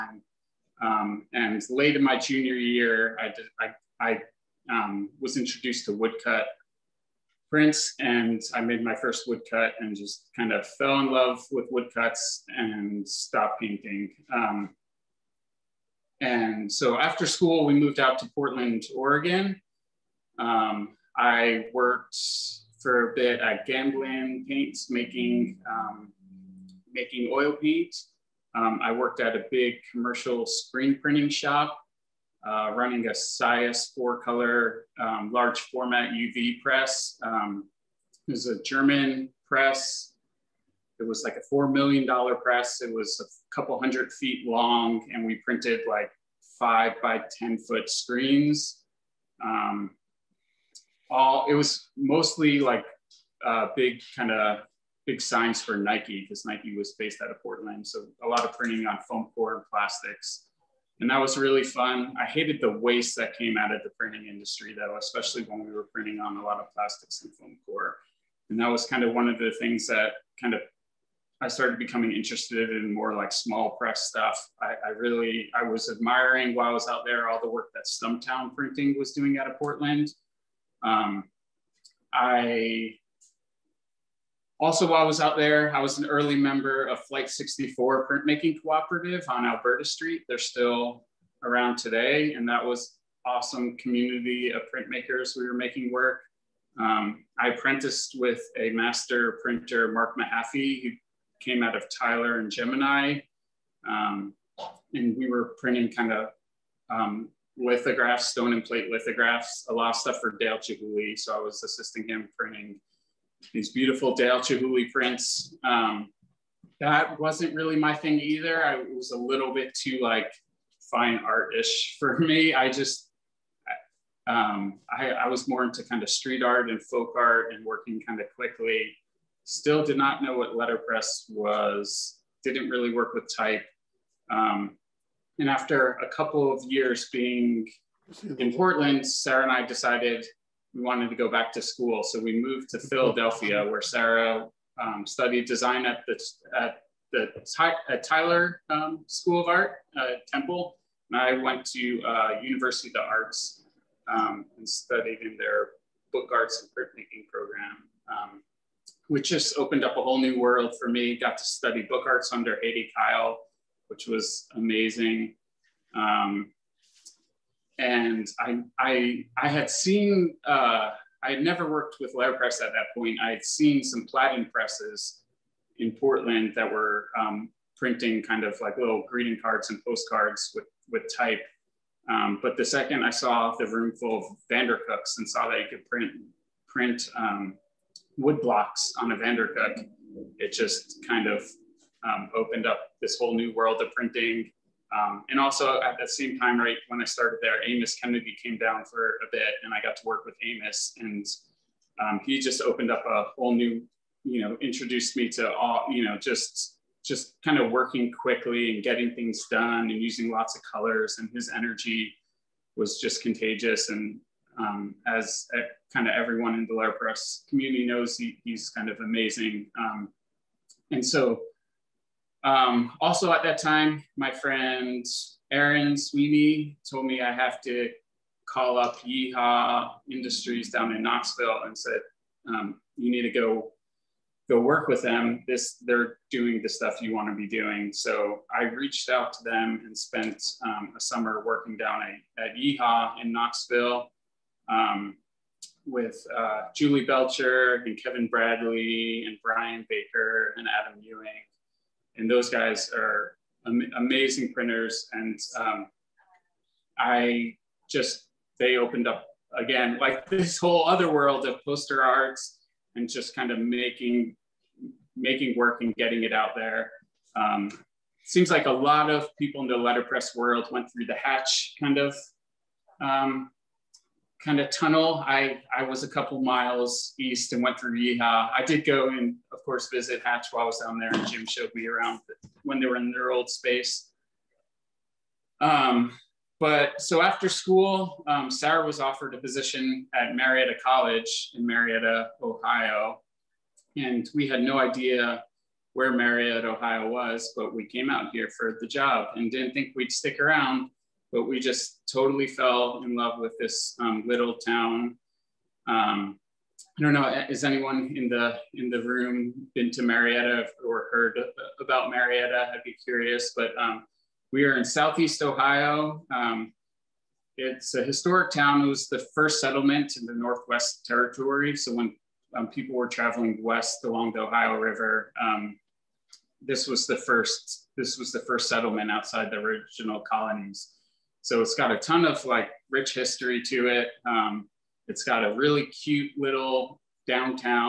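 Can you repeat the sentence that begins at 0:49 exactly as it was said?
Um, all, it was mostly like uh, big kind of big signs for Nike because Nike was based out of Portland.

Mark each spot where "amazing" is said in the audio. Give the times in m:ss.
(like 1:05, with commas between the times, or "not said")
2:44, 3:39, 4:13.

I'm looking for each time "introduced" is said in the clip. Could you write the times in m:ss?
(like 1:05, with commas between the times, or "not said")
0:05, 3:24.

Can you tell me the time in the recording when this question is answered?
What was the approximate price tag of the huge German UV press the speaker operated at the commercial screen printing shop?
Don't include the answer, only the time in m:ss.
0:41.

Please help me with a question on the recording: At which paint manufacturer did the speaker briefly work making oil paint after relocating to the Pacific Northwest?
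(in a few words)
Gamblin Paints.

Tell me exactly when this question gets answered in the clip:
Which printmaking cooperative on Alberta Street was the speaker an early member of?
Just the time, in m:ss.
1:27.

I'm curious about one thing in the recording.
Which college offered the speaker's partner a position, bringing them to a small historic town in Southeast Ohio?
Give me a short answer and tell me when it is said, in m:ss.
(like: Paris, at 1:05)
Marietta College, at 4:50.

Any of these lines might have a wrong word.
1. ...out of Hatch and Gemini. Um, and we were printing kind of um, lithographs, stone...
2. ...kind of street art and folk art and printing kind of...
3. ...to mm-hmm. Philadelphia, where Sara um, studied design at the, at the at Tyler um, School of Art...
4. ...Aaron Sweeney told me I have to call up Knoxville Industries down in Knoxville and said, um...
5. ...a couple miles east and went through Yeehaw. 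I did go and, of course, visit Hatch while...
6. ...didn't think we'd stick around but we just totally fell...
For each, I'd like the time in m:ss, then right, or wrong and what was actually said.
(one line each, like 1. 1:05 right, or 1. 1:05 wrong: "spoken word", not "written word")
1. 1:41 wrong: "Tyler", not "Hatch"
2. 2:05 wrong: "working", not "printing"
3. 2:22 right
4. 3:45 wrong: "Yeehaw", not "Knoxville"
5. 4:36 right
6. 4:59 right.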